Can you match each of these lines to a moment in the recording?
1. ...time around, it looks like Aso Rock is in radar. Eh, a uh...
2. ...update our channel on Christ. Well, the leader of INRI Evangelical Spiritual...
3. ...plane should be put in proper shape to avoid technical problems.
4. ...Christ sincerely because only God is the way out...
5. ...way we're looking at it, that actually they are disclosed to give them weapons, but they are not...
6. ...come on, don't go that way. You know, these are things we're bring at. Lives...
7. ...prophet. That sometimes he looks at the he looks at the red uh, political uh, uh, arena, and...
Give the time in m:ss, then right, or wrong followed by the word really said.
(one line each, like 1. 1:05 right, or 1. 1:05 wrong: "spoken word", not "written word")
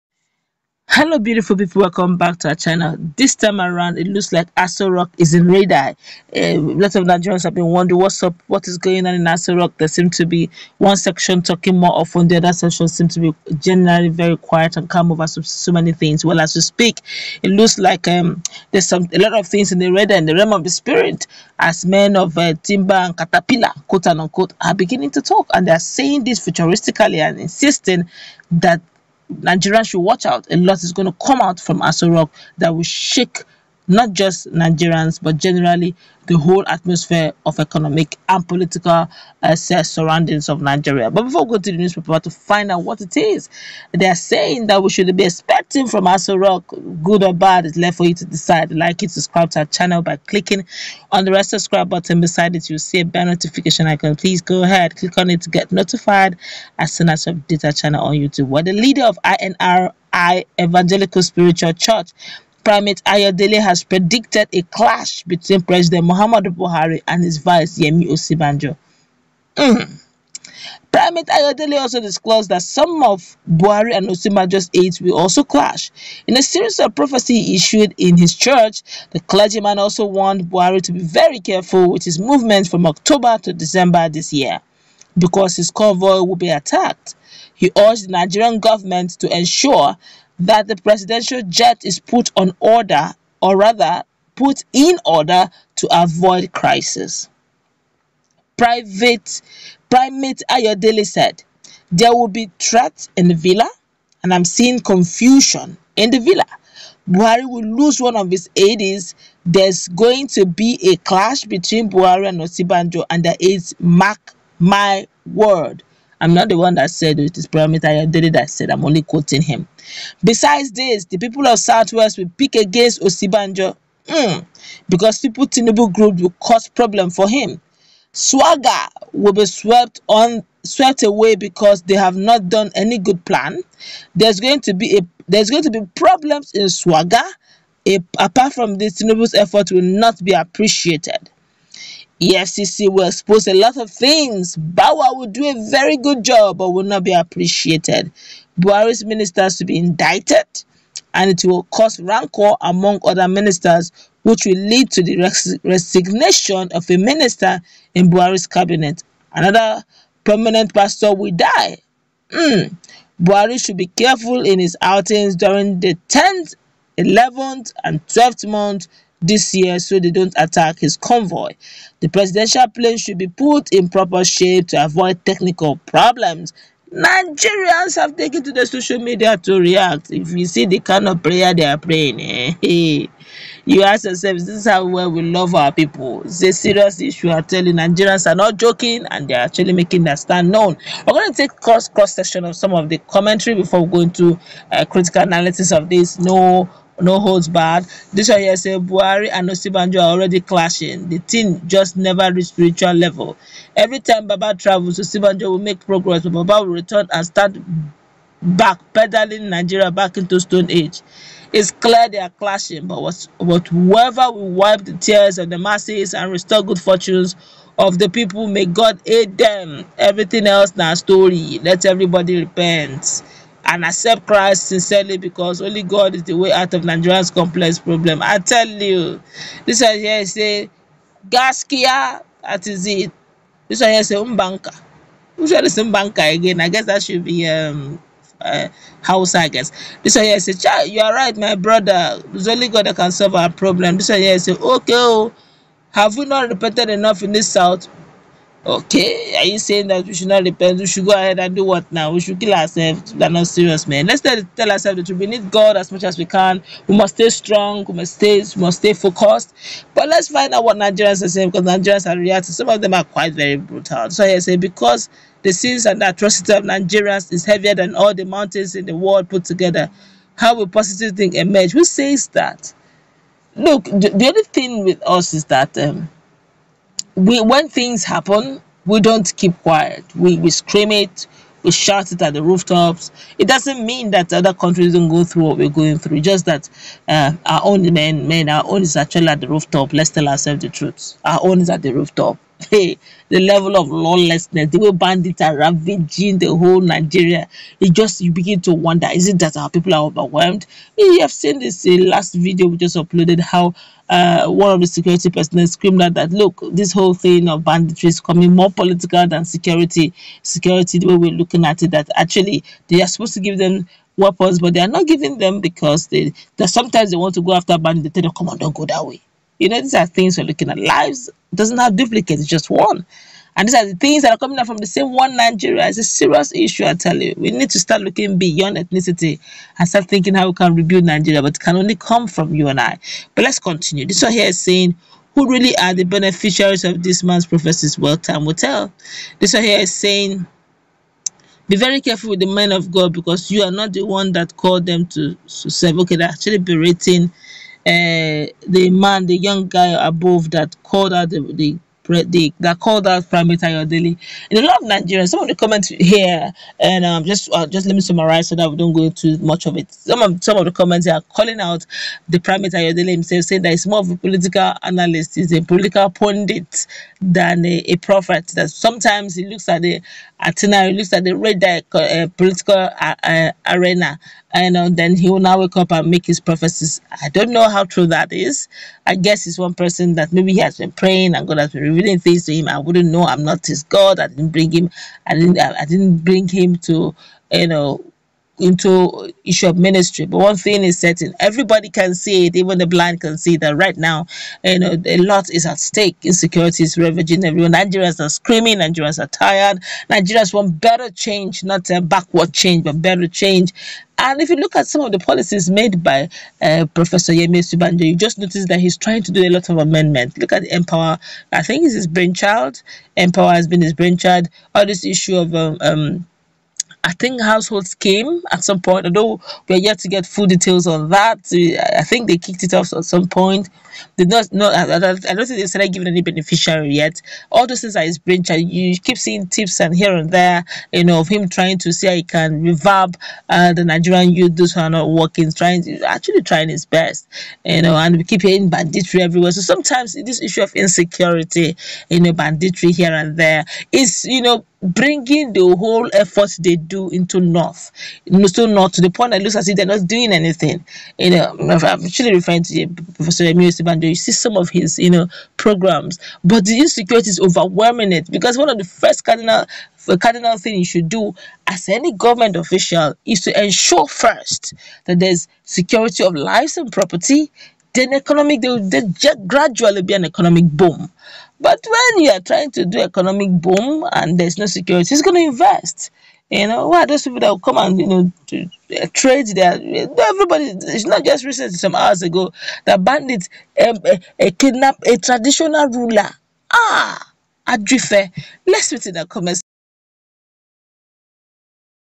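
1. 0:03 right
2. 0:57 wrong: "YouTube", not "Christ"
3. 2:52 right
4. 3:44 right
5. 5:11 wrong: "supposed", not "disclosed"
6. 5:18 wrong: "looking", not "bring"
7. 6:07 right.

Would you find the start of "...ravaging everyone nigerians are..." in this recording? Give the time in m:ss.
6:36.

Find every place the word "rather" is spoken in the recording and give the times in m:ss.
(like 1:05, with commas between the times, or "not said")
1:33.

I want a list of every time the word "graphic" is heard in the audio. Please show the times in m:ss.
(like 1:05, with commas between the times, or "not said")
not said.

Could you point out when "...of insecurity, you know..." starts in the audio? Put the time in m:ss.
7:20.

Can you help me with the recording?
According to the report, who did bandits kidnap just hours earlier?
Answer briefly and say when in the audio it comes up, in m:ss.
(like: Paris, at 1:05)
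A traditional ruler, at 8:05.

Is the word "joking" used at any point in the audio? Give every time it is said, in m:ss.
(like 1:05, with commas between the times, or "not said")
3:08.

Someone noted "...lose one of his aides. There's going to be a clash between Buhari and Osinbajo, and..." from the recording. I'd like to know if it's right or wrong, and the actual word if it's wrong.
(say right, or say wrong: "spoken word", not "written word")
right.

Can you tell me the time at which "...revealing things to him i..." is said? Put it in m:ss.
6:21.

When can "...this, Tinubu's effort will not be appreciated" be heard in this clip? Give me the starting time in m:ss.
2:18.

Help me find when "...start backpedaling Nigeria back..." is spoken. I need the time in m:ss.
3:27.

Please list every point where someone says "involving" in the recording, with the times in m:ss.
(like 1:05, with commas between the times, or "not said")
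not said.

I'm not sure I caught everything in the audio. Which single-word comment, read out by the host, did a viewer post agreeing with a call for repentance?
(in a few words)
Gaskia.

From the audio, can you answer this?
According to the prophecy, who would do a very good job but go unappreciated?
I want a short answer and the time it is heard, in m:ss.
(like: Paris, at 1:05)
Bawa, at 2:24.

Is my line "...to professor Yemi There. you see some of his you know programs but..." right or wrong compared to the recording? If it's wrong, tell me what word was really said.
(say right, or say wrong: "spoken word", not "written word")
wrong: "Osinbajo", not "There".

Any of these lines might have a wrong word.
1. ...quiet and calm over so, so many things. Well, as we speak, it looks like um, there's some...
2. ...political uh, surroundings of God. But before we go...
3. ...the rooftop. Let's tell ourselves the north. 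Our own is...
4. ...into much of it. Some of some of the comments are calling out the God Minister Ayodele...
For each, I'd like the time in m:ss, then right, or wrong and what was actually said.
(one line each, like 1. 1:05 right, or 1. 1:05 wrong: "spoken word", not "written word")
1. 0:14 right
2. 0:38 wrong: "Nigeria", not "God"
3. 4:49 wrong: "truth", not "north"
4. 5:59 wrong: "Prime", not "God".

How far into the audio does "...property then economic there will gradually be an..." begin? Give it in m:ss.
7:46.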